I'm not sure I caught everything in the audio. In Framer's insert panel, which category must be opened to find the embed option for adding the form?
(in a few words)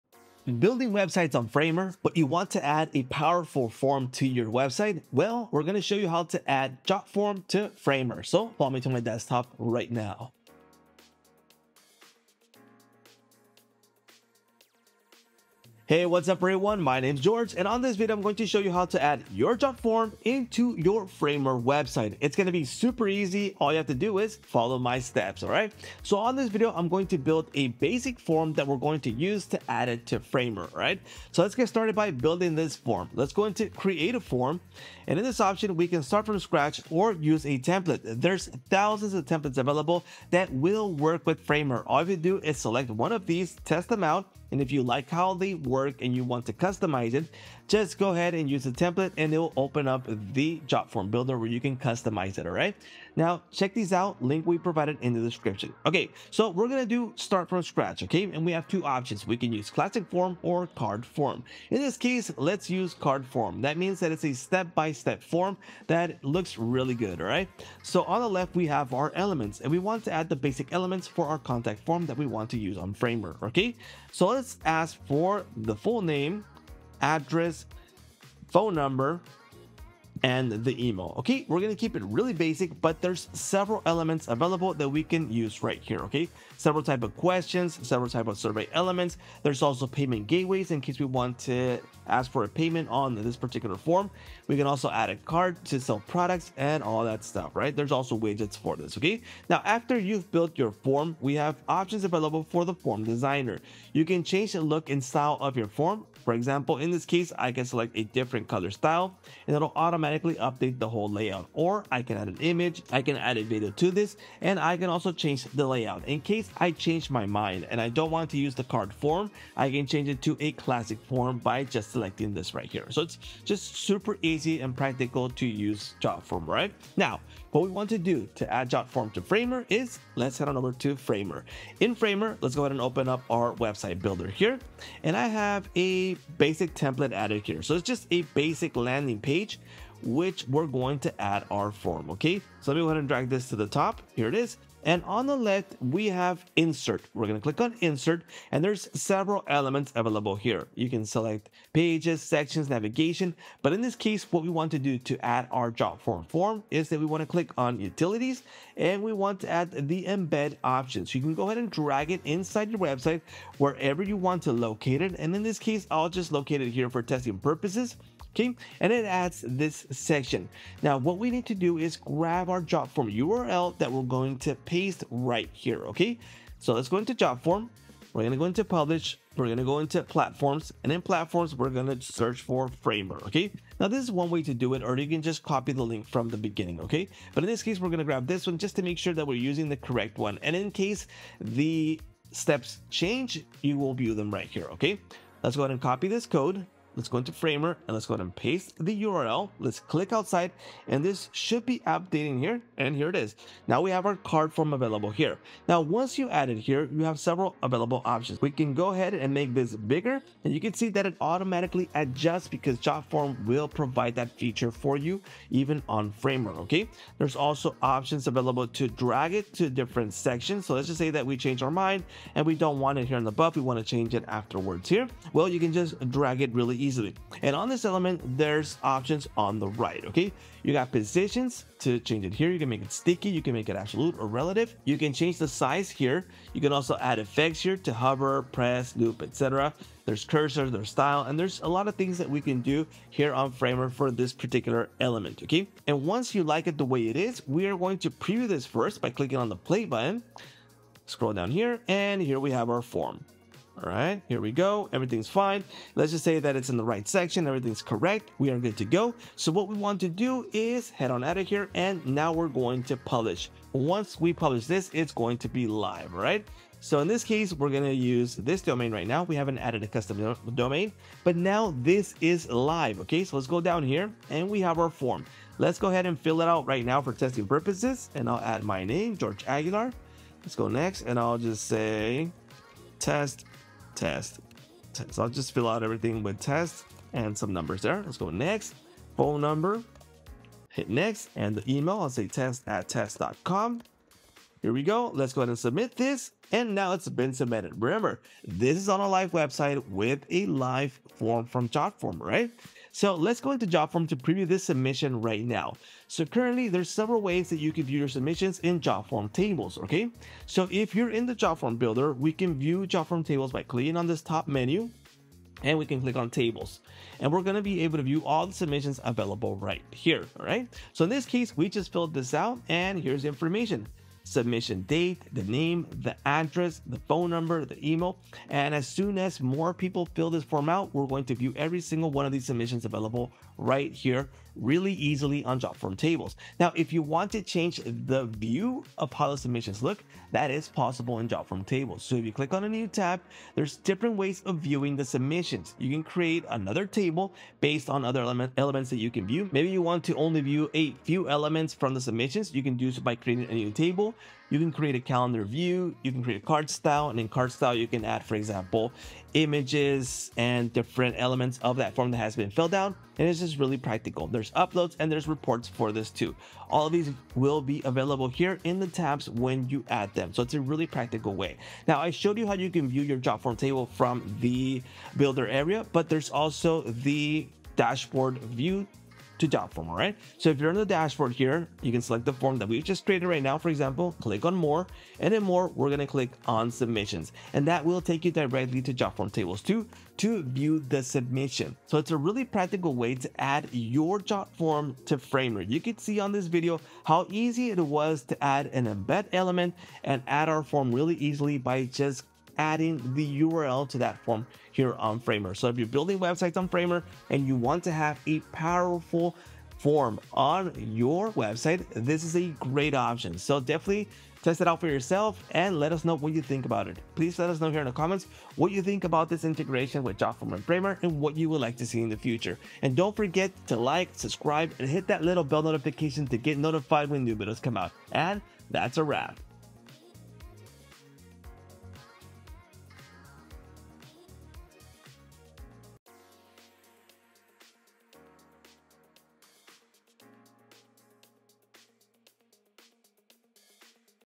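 Utilities.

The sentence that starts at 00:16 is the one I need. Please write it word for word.
My name is George and on this video, I'm going to show you how to add your JotForm into your Framer website.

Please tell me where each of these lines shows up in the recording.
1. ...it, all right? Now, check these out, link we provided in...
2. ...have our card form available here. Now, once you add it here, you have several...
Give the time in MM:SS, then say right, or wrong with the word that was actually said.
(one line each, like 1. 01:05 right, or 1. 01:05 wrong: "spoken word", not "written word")
1. 00:52 right
2. 03:23 right.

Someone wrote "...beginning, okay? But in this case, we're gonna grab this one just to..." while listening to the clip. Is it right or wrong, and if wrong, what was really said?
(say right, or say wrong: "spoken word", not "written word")
right.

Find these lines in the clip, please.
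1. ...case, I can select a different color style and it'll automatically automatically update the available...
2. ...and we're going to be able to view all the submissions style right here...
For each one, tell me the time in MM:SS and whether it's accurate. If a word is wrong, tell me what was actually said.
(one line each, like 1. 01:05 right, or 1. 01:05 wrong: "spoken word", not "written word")
1. 01:47 wrong: "whole", not "available"
2. 05:17 wrong: "available", not "style".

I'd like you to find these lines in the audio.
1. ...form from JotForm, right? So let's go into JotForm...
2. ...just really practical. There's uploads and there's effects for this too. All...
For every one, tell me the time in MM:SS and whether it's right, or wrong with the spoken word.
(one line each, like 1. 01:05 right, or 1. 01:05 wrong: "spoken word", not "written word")
1. 05:01 right
2. 06:03 wrong: "reports", not "effects".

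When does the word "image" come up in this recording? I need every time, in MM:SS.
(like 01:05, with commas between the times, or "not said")
01:52, 05:59.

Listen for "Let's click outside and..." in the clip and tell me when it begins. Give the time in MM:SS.
03:19.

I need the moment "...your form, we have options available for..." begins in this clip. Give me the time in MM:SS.
01:40.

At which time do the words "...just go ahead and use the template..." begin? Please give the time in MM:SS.
00:47.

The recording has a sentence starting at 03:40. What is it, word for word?
So let's just say that we change our mind and we don't want it here in the buff.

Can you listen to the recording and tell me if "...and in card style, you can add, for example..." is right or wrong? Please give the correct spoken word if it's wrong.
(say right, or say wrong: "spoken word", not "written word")
right.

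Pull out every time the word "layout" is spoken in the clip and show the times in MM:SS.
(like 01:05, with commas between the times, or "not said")
01:51, 01:55.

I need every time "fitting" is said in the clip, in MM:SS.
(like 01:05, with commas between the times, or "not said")
not said.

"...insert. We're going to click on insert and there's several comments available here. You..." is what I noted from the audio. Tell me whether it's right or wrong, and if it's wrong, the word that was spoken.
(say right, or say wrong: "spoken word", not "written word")
wrong: "elements", not "comments".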